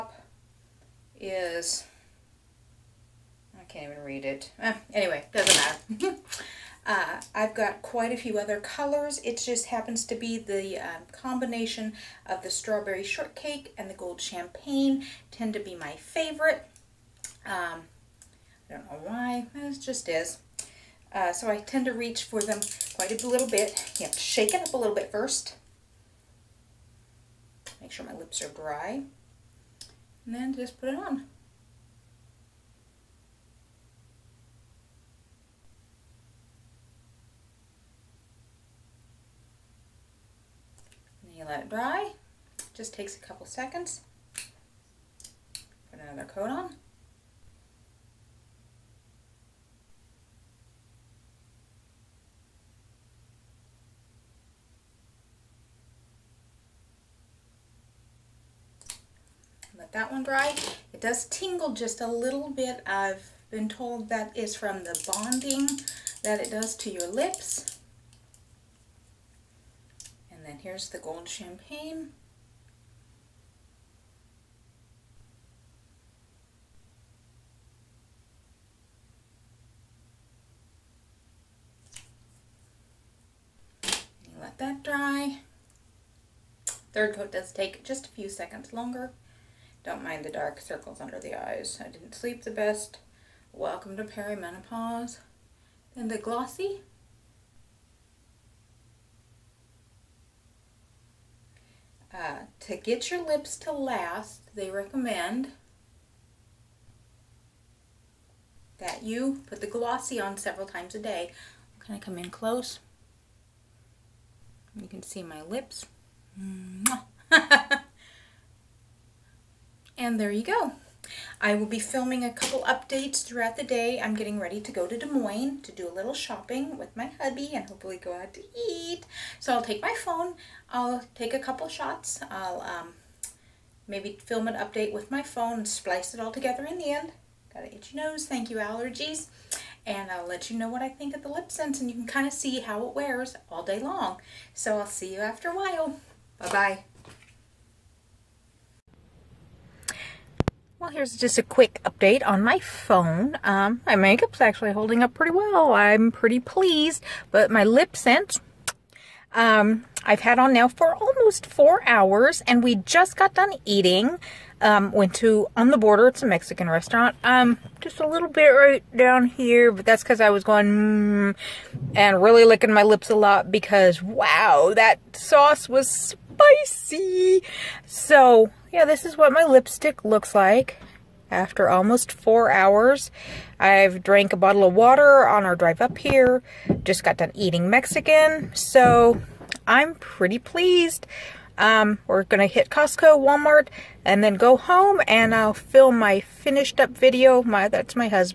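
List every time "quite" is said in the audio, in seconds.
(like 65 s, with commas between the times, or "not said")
7 s, 22 s.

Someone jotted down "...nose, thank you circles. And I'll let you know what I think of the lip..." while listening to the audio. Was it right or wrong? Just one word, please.
wrong.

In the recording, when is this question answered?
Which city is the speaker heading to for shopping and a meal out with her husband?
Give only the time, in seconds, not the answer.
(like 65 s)
124 s.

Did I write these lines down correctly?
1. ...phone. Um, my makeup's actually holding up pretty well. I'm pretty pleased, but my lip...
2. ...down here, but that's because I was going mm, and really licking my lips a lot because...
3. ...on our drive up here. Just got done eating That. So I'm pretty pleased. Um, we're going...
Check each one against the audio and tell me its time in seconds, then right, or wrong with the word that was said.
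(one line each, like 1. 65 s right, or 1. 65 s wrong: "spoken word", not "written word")
1. 152 s right
2. 168 s right
3. 185 s wrong: "Mexican", not "That".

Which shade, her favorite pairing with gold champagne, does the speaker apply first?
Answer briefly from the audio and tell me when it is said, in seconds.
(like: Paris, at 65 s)
Strawberry shortcake, at 12 s.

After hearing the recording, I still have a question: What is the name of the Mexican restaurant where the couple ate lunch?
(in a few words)
On the Border.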